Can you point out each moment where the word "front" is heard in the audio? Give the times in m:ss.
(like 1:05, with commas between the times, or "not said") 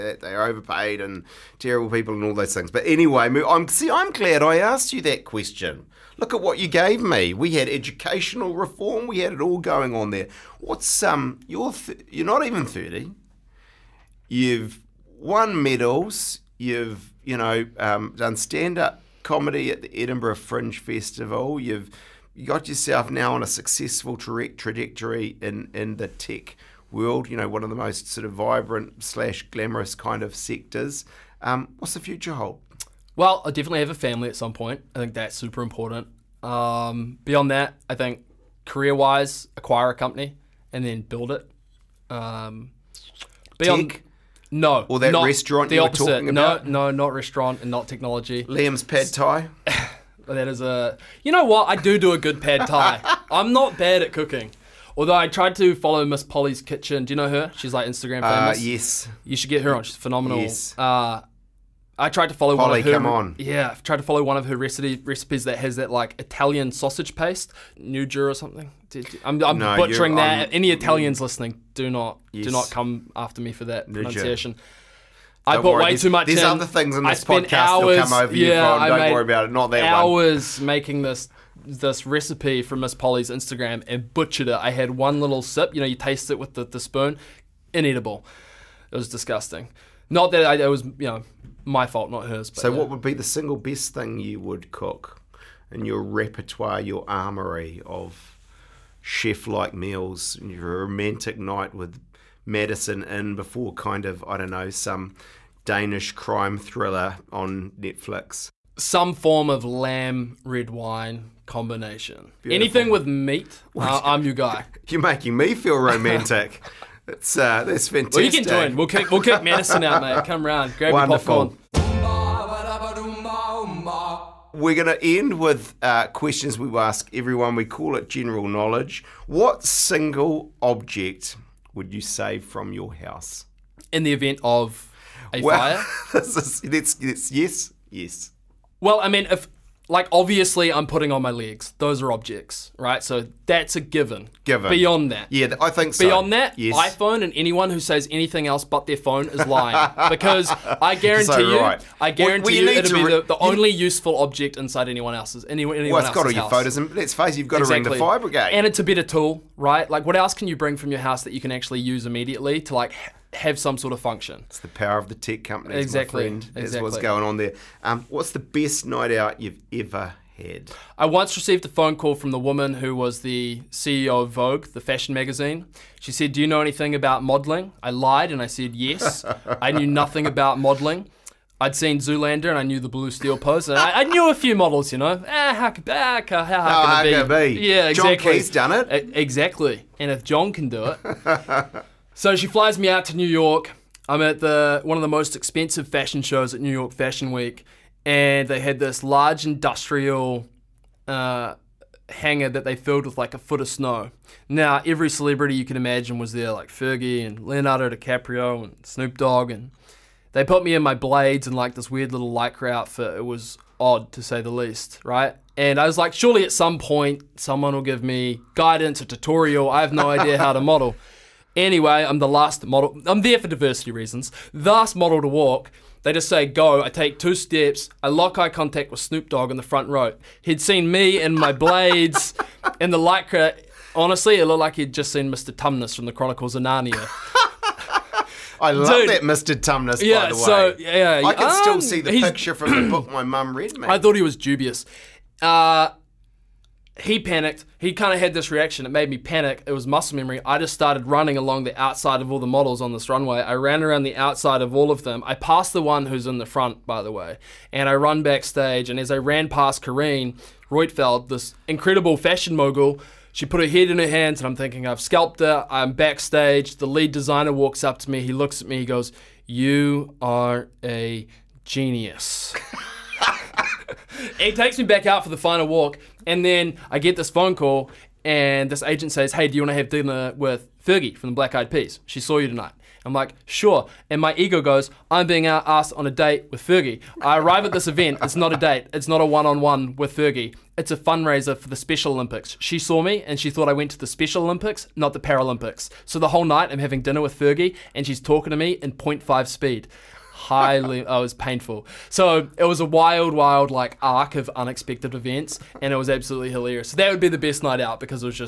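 3:49, 4:16.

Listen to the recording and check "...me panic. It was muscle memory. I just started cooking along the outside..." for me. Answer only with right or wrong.
wrong.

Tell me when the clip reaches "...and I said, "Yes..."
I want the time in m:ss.
2:58.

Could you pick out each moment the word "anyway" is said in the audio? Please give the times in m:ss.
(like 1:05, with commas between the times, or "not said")
0:02, 3:41.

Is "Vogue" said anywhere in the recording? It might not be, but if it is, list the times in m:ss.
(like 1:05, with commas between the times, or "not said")
2:54.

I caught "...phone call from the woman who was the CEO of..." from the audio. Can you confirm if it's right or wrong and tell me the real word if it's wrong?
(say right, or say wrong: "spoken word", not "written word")
right.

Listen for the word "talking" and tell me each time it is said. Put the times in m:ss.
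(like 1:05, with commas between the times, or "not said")
0:46, 4:58.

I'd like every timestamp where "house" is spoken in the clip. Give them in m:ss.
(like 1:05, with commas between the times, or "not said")
2:12, 2:36, 2:40.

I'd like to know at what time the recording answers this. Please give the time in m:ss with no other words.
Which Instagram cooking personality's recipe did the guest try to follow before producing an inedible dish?
0:56.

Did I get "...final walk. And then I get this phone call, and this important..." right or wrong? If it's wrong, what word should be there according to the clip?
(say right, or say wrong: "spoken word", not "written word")
wrong: "agent", not "important".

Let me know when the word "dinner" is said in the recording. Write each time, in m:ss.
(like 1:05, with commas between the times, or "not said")
4:39, 4:57.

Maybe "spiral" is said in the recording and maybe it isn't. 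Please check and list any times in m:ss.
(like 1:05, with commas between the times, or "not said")
not said.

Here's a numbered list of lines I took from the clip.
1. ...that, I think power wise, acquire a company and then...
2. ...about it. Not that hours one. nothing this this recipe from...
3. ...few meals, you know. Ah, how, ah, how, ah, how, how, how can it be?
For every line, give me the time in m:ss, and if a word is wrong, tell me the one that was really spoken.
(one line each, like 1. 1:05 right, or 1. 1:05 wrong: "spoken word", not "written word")
1. 0:37 wrong: "career", not "power"
2. 1:19 wrong: "making", not "nothing"
3. 3:04 wrong: "models", not "meals".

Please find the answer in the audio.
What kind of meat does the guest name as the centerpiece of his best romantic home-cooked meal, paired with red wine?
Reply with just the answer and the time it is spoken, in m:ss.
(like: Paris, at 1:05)
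Lamb, at 1:49.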